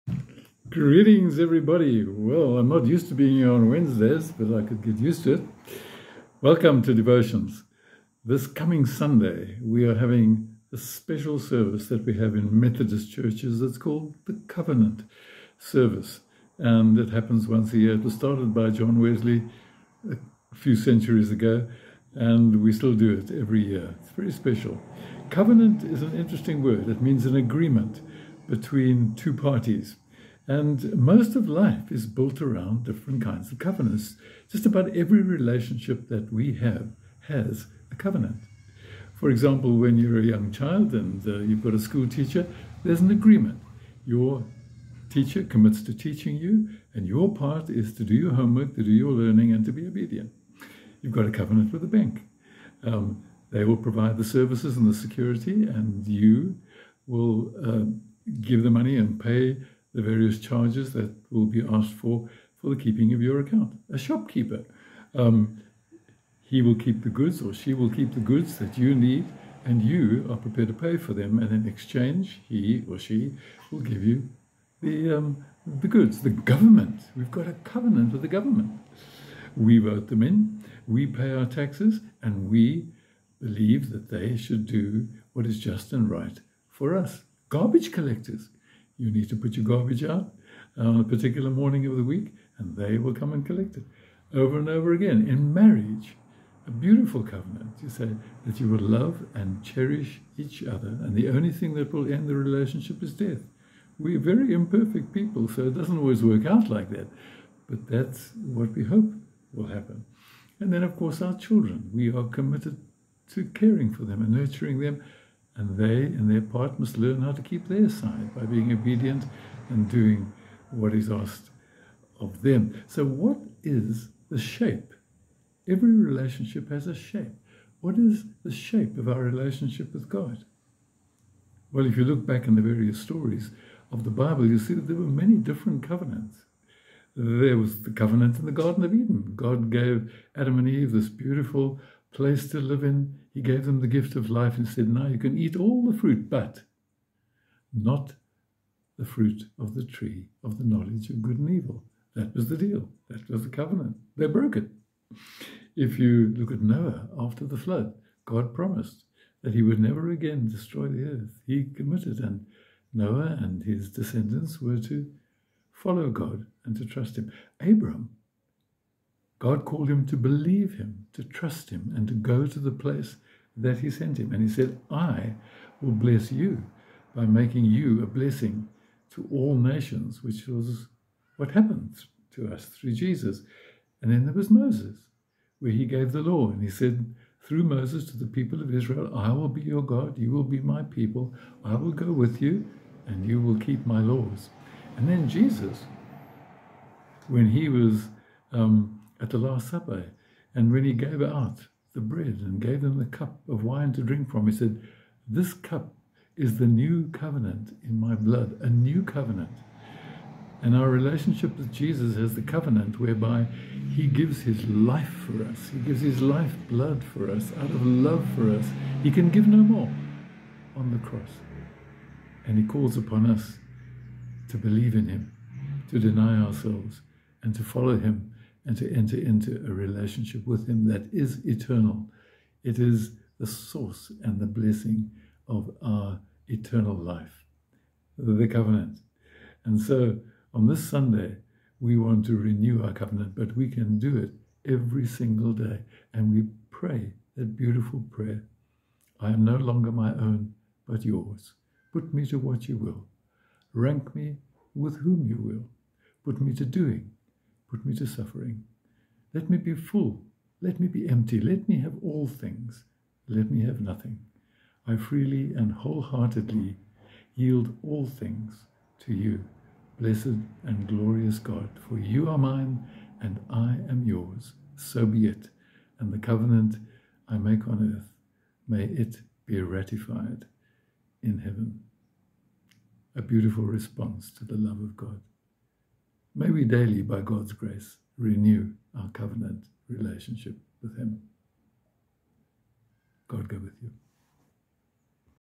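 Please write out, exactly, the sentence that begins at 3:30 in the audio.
And our relationship with Jesus has the covenant whereby he gives his life for us.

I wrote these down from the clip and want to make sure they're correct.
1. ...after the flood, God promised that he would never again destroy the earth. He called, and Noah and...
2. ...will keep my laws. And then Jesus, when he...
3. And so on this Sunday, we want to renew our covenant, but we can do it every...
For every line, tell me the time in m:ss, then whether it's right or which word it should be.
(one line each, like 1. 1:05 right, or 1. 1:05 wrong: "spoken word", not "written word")
1. 2:37 wrong: "committed", not "called"
2. 3:13 right
3. 3:59 right.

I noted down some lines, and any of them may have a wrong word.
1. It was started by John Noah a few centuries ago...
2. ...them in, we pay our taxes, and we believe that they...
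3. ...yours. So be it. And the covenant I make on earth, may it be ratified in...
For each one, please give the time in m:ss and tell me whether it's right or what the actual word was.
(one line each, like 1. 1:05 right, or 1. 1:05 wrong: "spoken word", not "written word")
1. 0:17 wrong: "Wesley", not "Noah"
2. 1:20 right
3. 4:34 right.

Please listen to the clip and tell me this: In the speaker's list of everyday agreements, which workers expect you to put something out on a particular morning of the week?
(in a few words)
Garbage collectors.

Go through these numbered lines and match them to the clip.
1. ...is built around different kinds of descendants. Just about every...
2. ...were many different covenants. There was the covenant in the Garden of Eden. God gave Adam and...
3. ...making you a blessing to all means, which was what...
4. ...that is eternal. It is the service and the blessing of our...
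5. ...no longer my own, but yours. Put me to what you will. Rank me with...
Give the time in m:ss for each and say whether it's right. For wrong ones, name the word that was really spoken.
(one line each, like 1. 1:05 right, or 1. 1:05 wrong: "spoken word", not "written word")
1. 0:31 wrong: "covenants", not "descendants"
2. 2:14 right
3. 2:57 wrong: "nations", not "means"
4. 3:50 wrong: "source", not "service"
5. 4:09 right.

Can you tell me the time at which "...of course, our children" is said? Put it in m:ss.
1:50.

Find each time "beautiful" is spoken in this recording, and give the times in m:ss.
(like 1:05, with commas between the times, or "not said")
1:36, 2:21, 4:07, 4:43.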